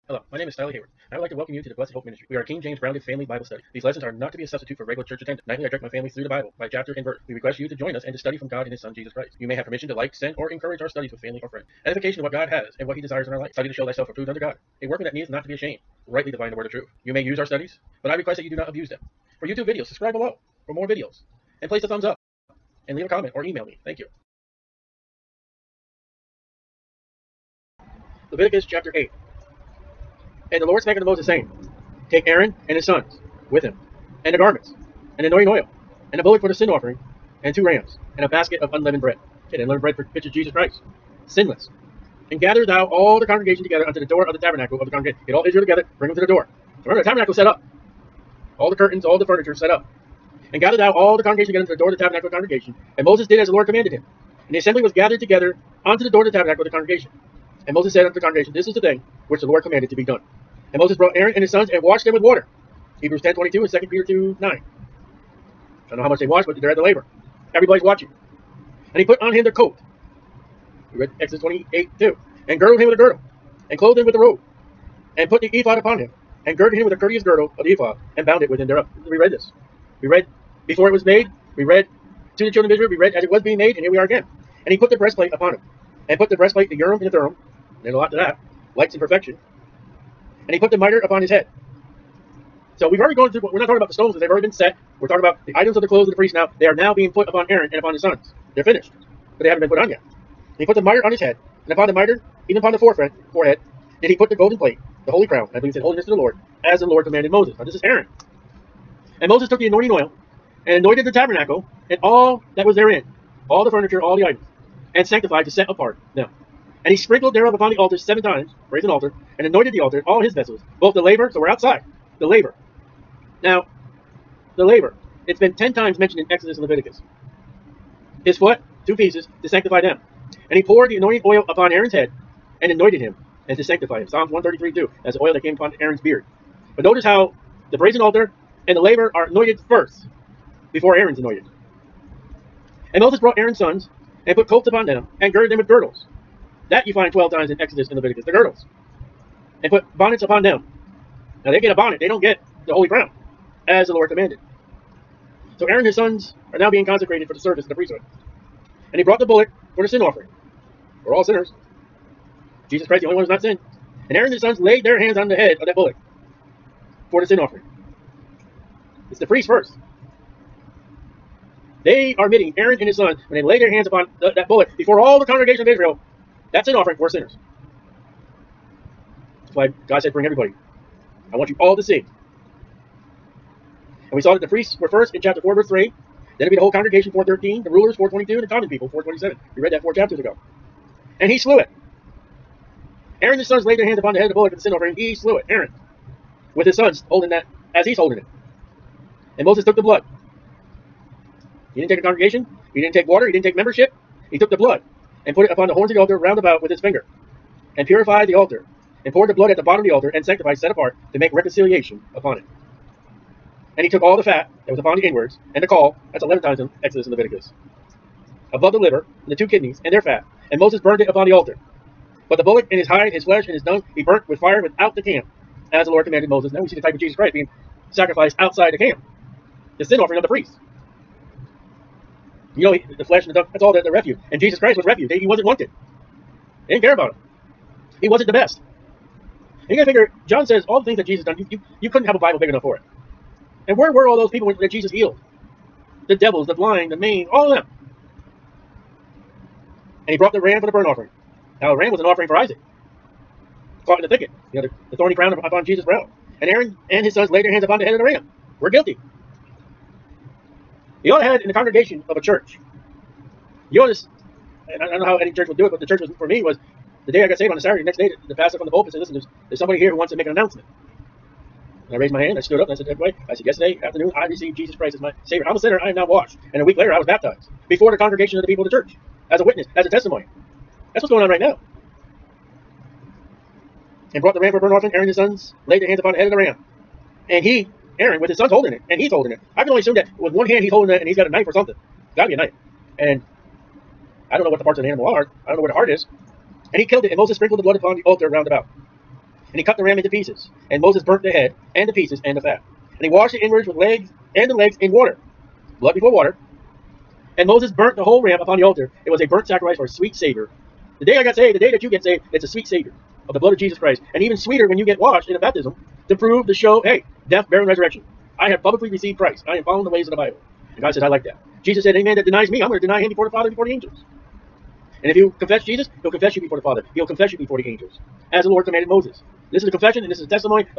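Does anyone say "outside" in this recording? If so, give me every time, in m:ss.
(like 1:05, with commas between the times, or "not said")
2:01, 3:48.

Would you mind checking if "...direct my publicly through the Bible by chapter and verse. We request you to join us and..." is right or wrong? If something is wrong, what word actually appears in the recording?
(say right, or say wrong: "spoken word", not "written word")
wrong: "family", not "publicly".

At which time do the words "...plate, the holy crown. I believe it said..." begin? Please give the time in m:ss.
1:44.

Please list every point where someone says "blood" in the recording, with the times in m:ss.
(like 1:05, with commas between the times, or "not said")
3:19, 3:24, 3:29, 4:57, 5:05, 5:13.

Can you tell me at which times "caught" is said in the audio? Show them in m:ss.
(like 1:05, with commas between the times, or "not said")
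4:13.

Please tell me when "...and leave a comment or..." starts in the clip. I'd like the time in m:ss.
0:22.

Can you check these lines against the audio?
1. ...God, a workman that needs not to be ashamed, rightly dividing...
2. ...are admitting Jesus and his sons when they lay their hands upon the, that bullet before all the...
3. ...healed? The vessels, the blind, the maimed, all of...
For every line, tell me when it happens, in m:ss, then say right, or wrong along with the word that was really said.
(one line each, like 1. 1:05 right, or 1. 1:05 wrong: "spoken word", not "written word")
1. 0:14 right
2. 2:52 wrong: "Aaron", not "Jesus"
3. 4:04 wrong: "devils", not "vessels".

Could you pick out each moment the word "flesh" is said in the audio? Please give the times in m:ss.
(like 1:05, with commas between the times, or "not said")
3:43, 3:53.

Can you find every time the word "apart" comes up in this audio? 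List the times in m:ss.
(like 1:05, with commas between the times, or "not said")
1:55, 3:30.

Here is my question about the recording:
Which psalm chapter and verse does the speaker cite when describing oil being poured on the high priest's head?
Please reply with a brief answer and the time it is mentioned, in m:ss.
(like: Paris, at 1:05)
Psalms 133:2, at 2:14.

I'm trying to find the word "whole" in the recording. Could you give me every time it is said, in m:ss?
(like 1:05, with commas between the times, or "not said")
3:06, 5:08.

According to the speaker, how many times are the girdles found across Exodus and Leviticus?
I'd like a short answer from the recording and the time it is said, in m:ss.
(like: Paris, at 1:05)
12, at 2:27.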